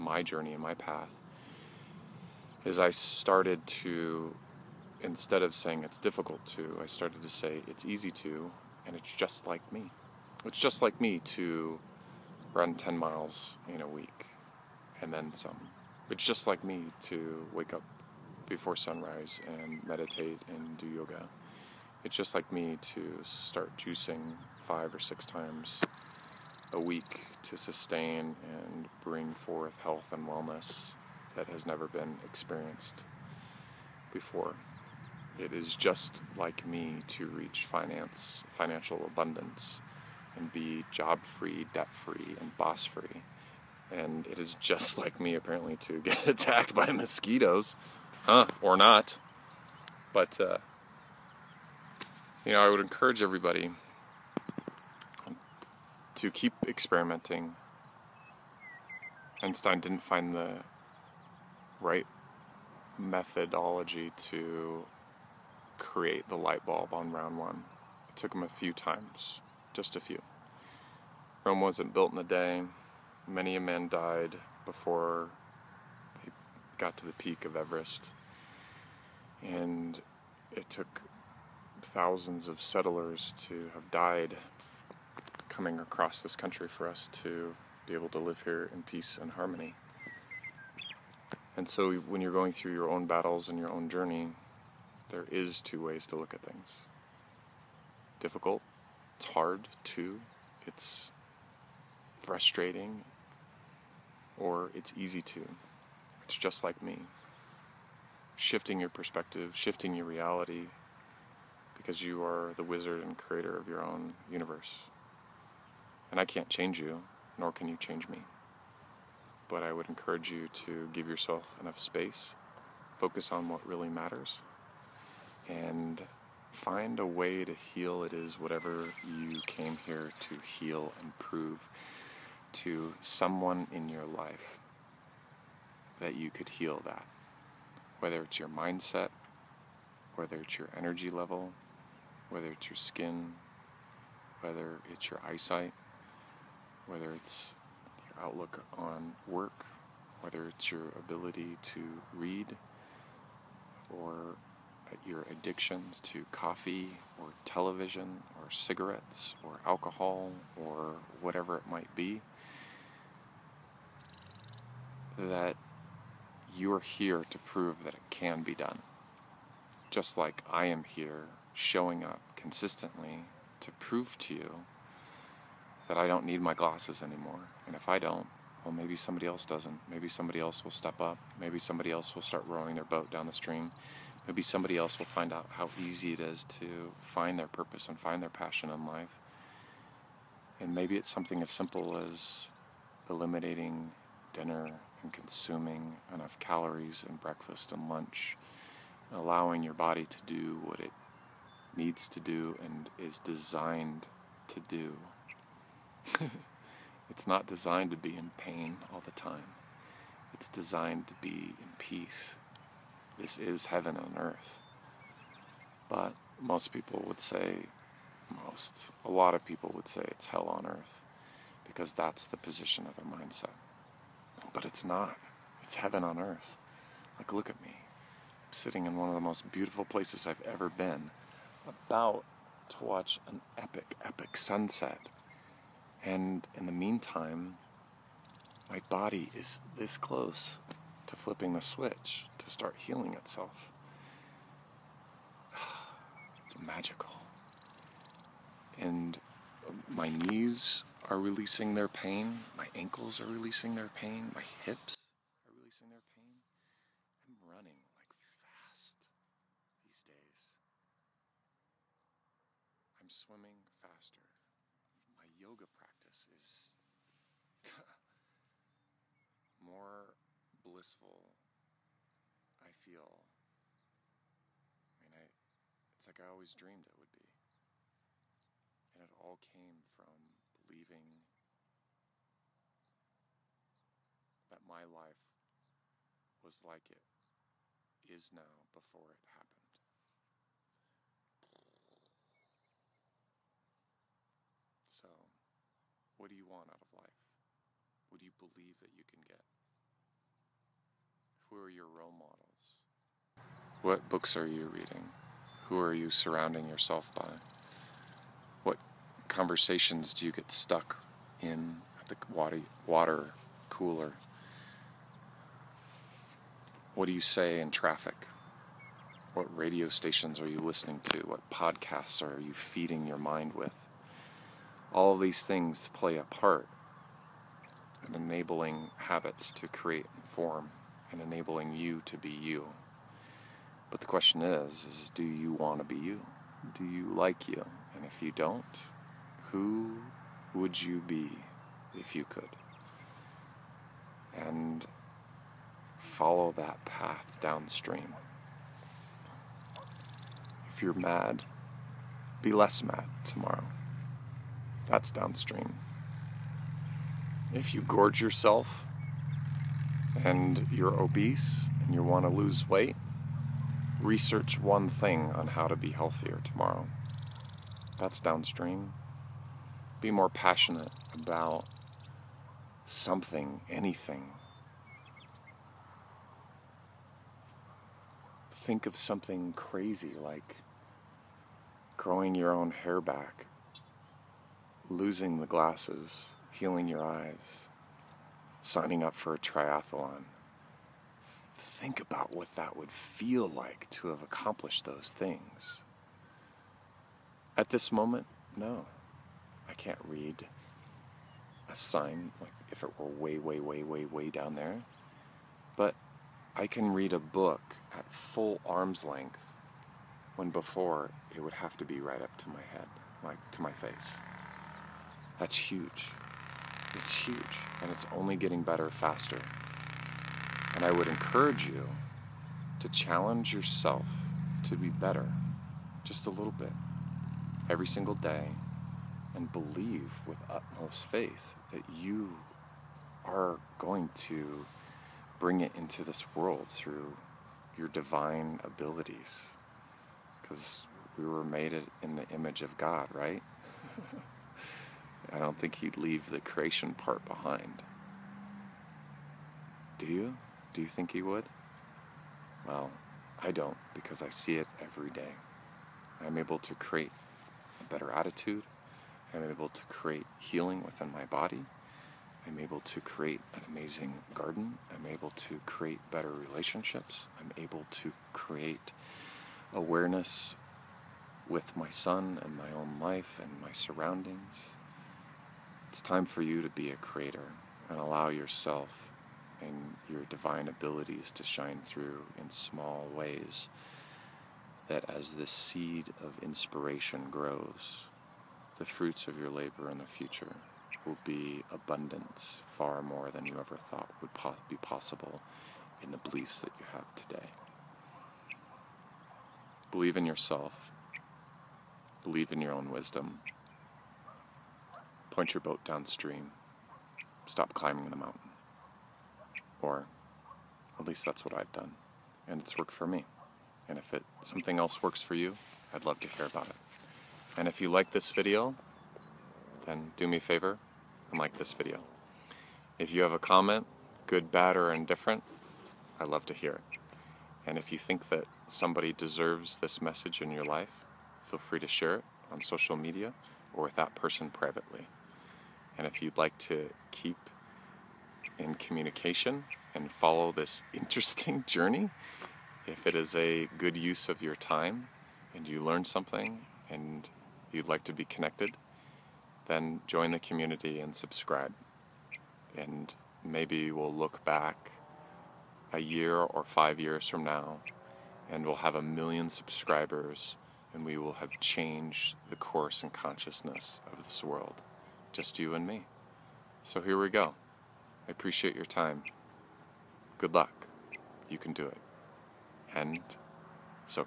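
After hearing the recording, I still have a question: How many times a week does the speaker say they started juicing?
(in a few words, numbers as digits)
five or six.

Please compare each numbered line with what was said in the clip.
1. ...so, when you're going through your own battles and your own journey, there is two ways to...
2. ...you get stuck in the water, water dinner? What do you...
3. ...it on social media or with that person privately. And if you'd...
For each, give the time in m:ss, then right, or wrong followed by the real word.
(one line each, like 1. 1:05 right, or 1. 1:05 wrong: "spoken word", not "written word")
1. 1:31 right
2. 5:10 wrong: "cooler", not "dinner"
3. 8:52 right.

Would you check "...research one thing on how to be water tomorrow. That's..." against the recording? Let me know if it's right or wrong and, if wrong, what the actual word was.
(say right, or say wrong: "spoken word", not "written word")
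wrong: "healthier", not "water".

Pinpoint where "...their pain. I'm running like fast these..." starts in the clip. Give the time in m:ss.
4:15.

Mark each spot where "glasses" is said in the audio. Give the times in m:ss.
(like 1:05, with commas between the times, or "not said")
2:56, 6:25.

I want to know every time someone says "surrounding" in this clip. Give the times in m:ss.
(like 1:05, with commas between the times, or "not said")
5:06, 7:53.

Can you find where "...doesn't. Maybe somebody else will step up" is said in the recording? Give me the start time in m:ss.
2:59.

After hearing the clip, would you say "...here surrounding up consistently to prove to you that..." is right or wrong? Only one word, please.
wrong.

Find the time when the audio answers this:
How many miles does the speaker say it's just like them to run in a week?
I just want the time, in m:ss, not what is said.
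0:12.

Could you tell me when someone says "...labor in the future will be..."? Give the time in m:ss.
8:09.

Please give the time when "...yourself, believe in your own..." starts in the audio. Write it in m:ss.
8:20.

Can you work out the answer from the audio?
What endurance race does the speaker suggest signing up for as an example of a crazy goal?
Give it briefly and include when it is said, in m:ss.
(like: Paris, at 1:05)
triathlon, at 6:29.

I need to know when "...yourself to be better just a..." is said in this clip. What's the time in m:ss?
7:03.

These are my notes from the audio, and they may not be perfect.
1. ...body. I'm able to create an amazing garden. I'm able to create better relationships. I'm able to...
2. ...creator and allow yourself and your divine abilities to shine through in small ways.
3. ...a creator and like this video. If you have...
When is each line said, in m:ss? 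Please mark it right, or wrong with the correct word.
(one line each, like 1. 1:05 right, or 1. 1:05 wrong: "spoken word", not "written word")
1. 7:41 right
2. 7:56 right
3. 8:40 wrong: "favor", not "creator".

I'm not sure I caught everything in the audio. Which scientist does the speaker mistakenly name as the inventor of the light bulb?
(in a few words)
Einstein.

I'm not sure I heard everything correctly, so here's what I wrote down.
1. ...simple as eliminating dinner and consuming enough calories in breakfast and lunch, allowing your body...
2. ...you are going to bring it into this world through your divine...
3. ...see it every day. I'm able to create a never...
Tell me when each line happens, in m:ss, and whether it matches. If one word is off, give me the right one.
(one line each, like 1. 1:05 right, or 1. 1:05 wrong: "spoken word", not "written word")
1. 3:11 right
2. 7:11 right
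3. 7:34 wrong: "better", not "never".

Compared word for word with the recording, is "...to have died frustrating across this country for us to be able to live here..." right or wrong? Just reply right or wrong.
wrong.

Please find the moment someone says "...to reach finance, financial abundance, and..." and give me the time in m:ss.
0:37.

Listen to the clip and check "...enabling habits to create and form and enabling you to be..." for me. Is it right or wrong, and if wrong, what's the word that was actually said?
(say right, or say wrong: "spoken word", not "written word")
right.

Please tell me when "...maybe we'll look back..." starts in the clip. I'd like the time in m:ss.
9:13.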